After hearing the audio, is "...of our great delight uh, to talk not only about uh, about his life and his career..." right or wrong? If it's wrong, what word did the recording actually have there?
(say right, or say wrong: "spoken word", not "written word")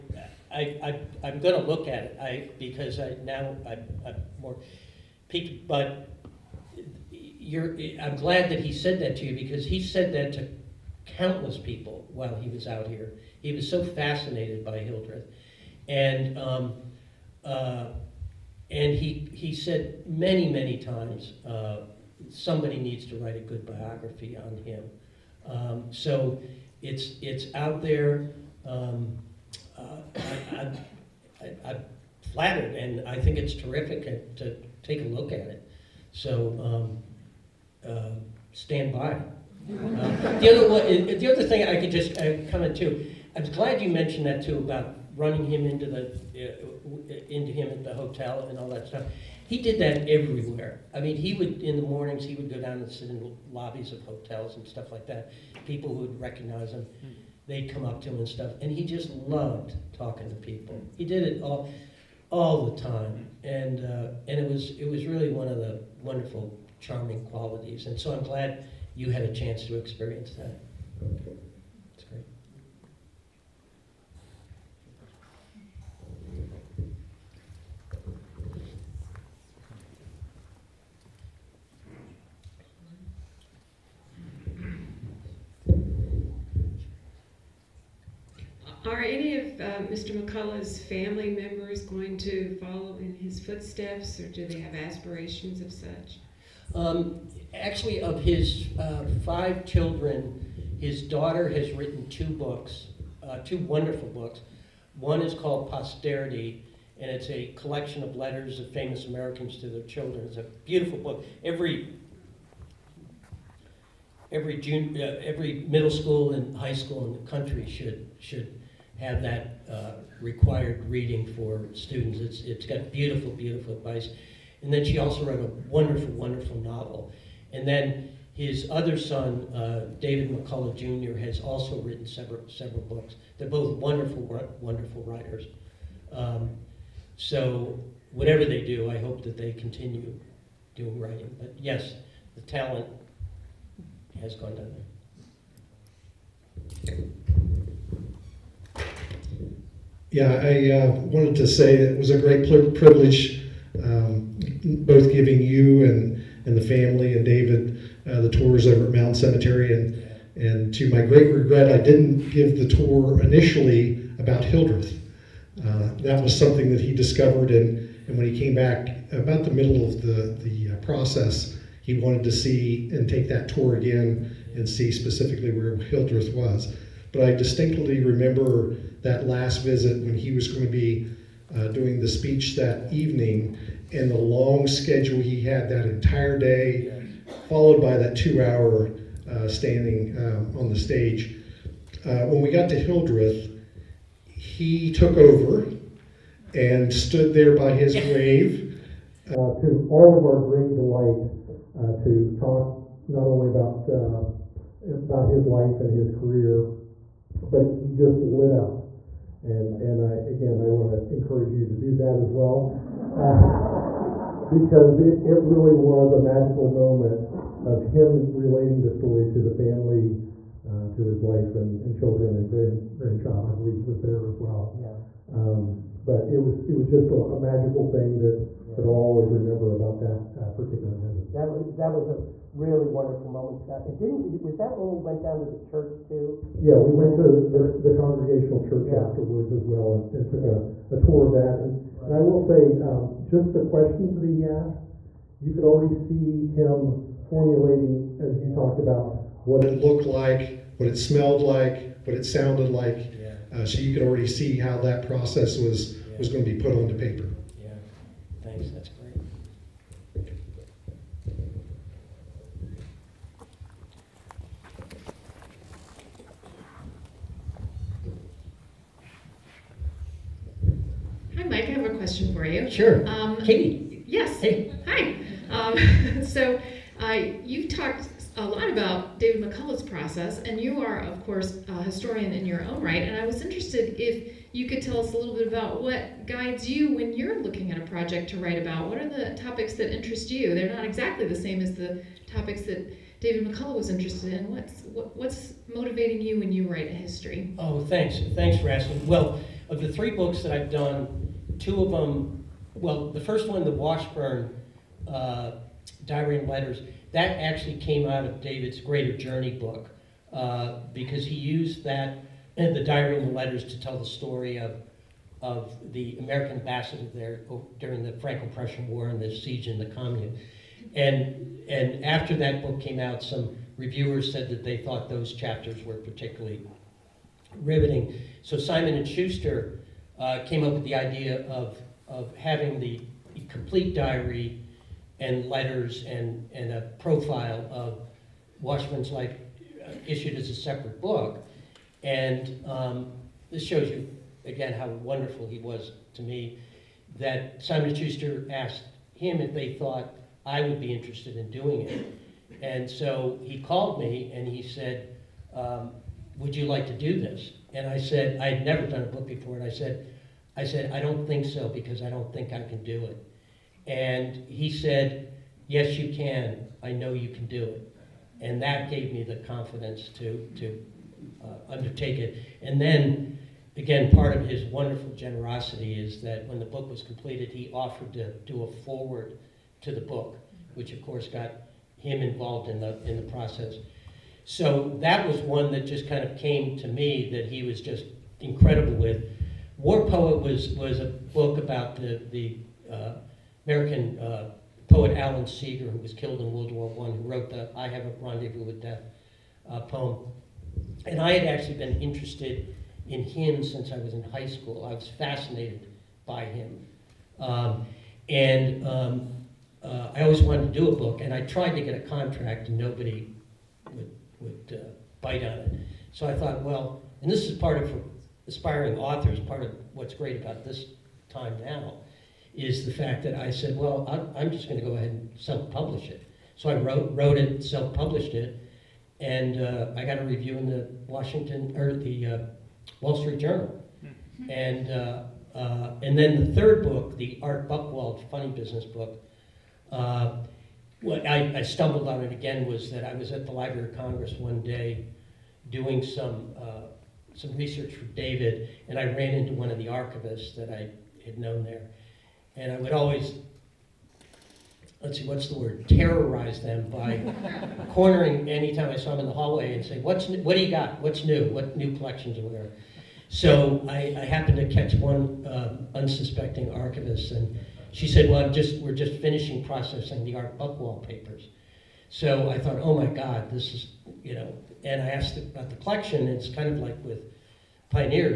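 right.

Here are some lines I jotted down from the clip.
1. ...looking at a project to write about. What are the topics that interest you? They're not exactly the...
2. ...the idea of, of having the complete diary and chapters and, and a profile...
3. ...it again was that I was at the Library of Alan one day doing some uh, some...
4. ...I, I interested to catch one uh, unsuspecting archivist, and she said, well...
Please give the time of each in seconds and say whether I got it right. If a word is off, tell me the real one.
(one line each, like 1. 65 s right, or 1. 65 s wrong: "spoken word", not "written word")
1. 287 s right
2. 330 s wrong: "letters", not "chapters"
3. 442 s wrong: "Congress", not "Alan"
4. 463 s wrong: "happened", not "interested".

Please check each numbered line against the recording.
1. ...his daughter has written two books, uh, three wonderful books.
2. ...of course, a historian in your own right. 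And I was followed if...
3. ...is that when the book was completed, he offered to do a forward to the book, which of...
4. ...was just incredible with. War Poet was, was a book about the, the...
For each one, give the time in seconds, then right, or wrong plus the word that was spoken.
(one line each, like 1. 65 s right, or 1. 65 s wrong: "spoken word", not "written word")
1. 100 s wrong: "two", not "three"
2. 280 s wrong: "interested", not "followed"
3. 375 s right
4. 387 s right.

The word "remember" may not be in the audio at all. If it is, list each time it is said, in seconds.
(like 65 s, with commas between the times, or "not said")
178 s, 229 s.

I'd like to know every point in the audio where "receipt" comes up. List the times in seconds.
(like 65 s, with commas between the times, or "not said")
not said.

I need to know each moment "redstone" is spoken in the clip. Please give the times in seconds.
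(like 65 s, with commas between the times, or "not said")
not said.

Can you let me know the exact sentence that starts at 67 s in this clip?
And so I'm glad you had a chance to experience that.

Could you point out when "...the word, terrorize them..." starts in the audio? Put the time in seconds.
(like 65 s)
455 s.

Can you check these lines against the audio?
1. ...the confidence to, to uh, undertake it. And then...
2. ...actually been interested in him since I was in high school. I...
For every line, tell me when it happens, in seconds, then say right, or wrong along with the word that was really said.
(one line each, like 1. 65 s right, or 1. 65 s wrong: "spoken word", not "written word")
1. 369 s right
2. 401 s right.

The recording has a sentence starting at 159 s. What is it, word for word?
And, and to my great regret, I didn't give the tour initially about Hildreth.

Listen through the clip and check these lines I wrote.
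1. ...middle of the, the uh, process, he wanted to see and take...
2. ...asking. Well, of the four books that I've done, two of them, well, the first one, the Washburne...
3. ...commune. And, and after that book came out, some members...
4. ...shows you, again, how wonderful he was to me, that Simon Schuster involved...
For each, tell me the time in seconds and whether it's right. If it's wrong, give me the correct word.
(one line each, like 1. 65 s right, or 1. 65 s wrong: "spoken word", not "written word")
1. 169 s right
2. 298 s wrong: "three", not "four"
3. 319 s wrong: "reviewers", not "members"
4. 343 s wrong: "asked", not "involved".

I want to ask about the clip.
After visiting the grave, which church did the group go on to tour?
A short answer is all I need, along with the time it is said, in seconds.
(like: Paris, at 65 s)
The congregational church, at 237 s.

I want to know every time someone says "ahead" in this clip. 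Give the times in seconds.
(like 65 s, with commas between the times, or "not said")
424 s.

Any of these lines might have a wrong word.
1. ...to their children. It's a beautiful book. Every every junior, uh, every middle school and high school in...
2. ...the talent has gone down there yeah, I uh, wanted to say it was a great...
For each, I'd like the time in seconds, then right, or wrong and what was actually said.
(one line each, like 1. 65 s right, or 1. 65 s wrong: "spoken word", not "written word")
1. 109 s right
2. 142 s right.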